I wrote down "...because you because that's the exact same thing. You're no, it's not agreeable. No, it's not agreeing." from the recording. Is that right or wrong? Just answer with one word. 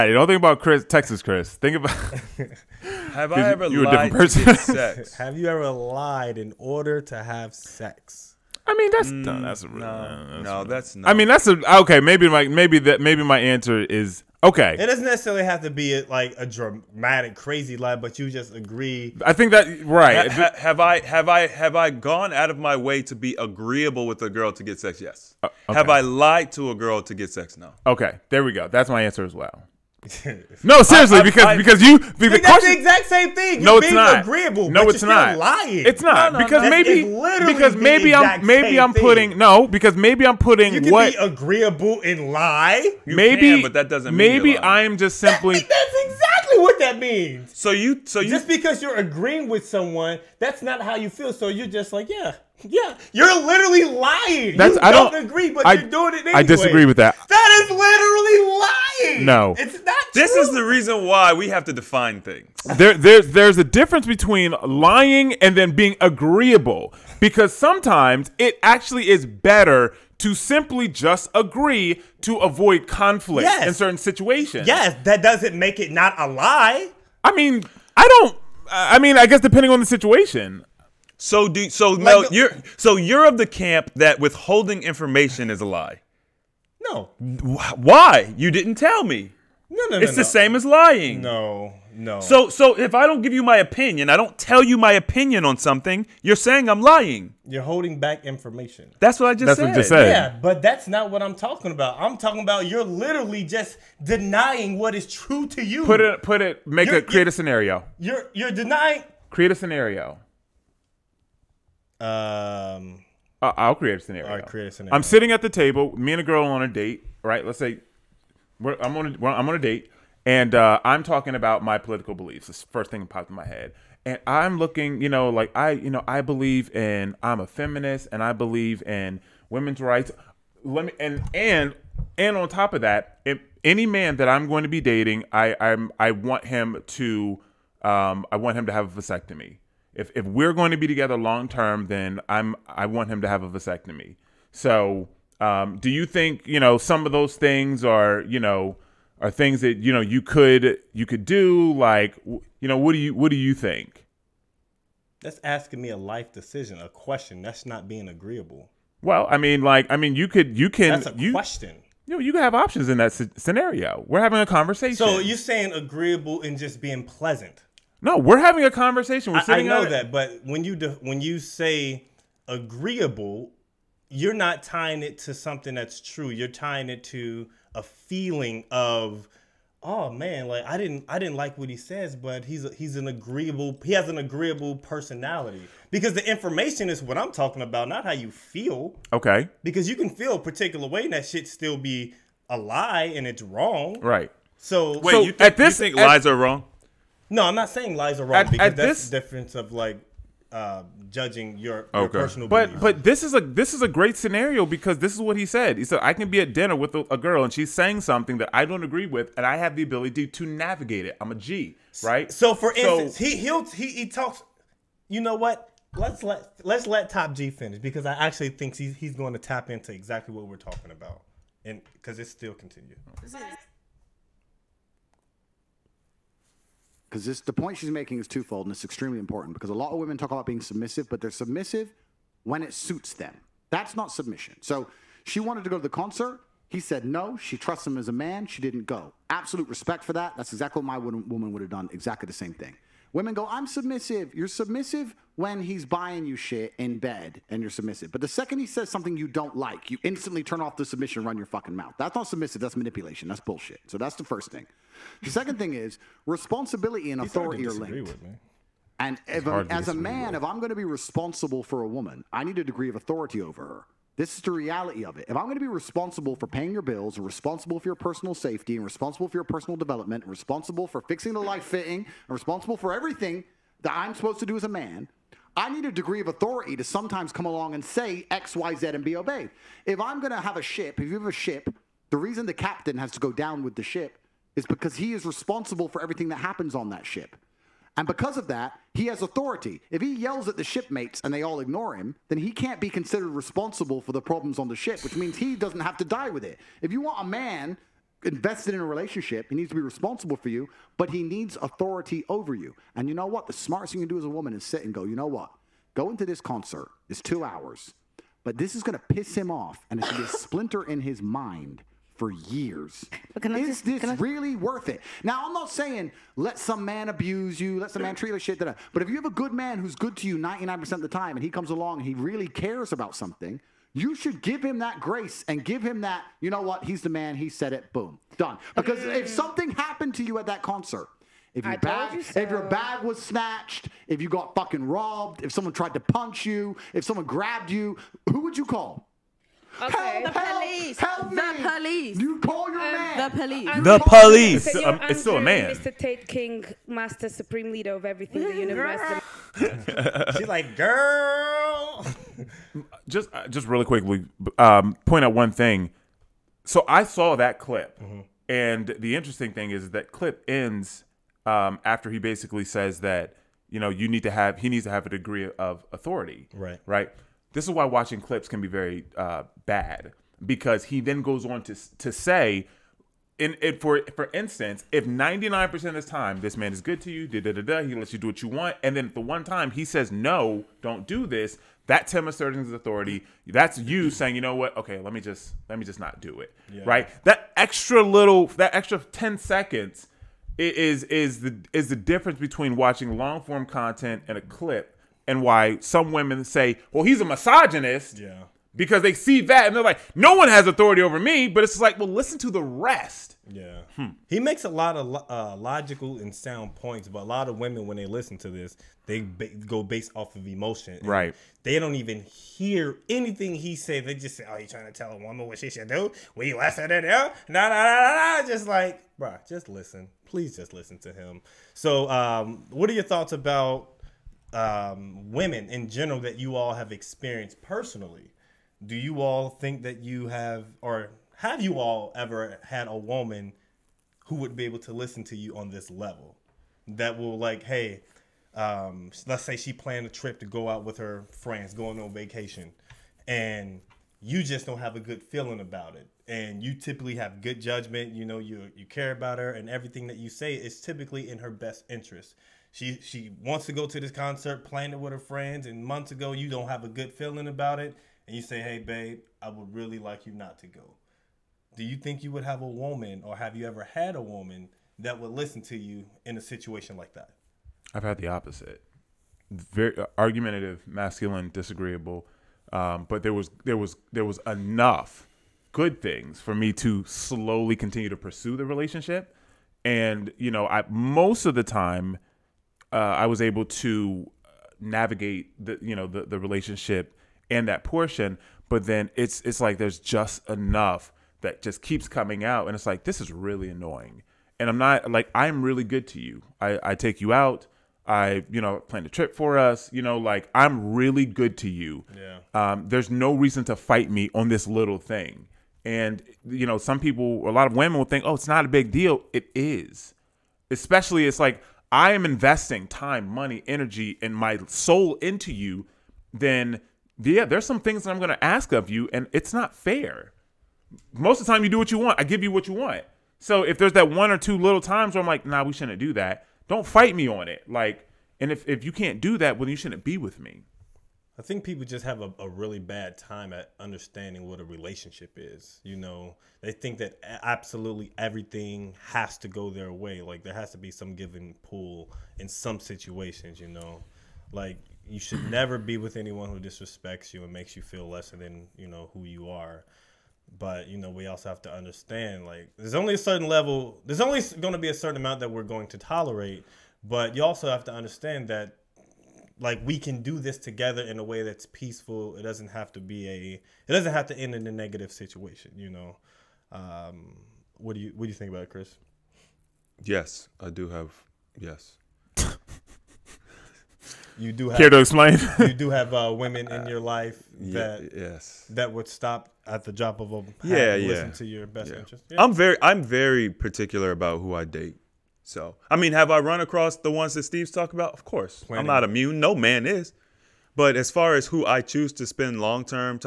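wrong.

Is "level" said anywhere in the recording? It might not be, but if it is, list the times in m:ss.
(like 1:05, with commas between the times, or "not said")
7:15, 9:13.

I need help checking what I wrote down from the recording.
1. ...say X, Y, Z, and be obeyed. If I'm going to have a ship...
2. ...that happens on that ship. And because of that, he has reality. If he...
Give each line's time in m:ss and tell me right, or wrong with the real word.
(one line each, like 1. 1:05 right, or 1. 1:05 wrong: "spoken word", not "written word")
1. 4:37 right
2. 4:46 wrong: "authority", not "reality".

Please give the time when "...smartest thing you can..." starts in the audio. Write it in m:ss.
5:03.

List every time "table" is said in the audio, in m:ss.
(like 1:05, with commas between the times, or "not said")
1:55.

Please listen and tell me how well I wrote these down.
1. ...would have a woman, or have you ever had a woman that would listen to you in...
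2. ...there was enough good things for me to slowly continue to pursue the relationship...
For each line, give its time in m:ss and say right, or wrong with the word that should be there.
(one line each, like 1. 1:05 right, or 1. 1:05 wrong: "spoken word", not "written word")
1. 7:42 right
2. 7:54 right.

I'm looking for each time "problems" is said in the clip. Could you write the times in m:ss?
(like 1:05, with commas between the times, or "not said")
4:54.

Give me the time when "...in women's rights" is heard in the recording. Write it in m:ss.
2:08.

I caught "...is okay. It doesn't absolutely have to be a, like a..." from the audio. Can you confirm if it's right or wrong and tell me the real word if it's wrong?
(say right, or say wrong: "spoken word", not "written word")
wrong: "necessarily", not "absolutely".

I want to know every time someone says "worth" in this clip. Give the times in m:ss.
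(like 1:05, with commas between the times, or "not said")
5:14.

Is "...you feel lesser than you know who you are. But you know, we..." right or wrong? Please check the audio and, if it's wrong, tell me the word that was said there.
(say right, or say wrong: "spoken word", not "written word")
right.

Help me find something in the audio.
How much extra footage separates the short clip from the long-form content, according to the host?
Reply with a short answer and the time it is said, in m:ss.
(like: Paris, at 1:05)
10 seconds, at 6:28.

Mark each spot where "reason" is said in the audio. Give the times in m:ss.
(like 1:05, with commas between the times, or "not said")
1:00, 4:42, 8:23.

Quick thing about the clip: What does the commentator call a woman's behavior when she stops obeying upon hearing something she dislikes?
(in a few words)
manipulation.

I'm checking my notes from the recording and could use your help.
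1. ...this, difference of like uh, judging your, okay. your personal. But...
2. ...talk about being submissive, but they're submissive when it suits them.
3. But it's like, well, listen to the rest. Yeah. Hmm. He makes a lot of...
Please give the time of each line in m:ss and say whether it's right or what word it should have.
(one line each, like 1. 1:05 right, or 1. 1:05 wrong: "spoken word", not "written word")
1. 3:19 right
2. 3:50 right
3. 6:41 right.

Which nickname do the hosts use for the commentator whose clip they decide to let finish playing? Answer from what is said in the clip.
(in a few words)
Top G.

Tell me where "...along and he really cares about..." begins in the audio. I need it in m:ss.
5:21.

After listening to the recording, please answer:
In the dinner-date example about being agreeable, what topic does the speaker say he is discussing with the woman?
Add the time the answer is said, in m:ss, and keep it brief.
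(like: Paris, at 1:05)
political beliefs, at 2:01.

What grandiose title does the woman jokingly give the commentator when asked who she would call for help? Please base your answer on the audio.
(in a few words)
supreme leader of everything.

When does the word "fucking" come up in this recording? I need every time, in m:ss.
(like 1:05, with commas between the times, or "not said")
4:11, 5:34.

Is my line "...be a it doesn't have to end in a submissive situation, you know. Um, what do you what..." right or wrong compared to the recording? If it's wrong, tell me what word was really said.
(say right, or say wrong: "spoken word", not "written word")
wrong: "negative", not "submissive".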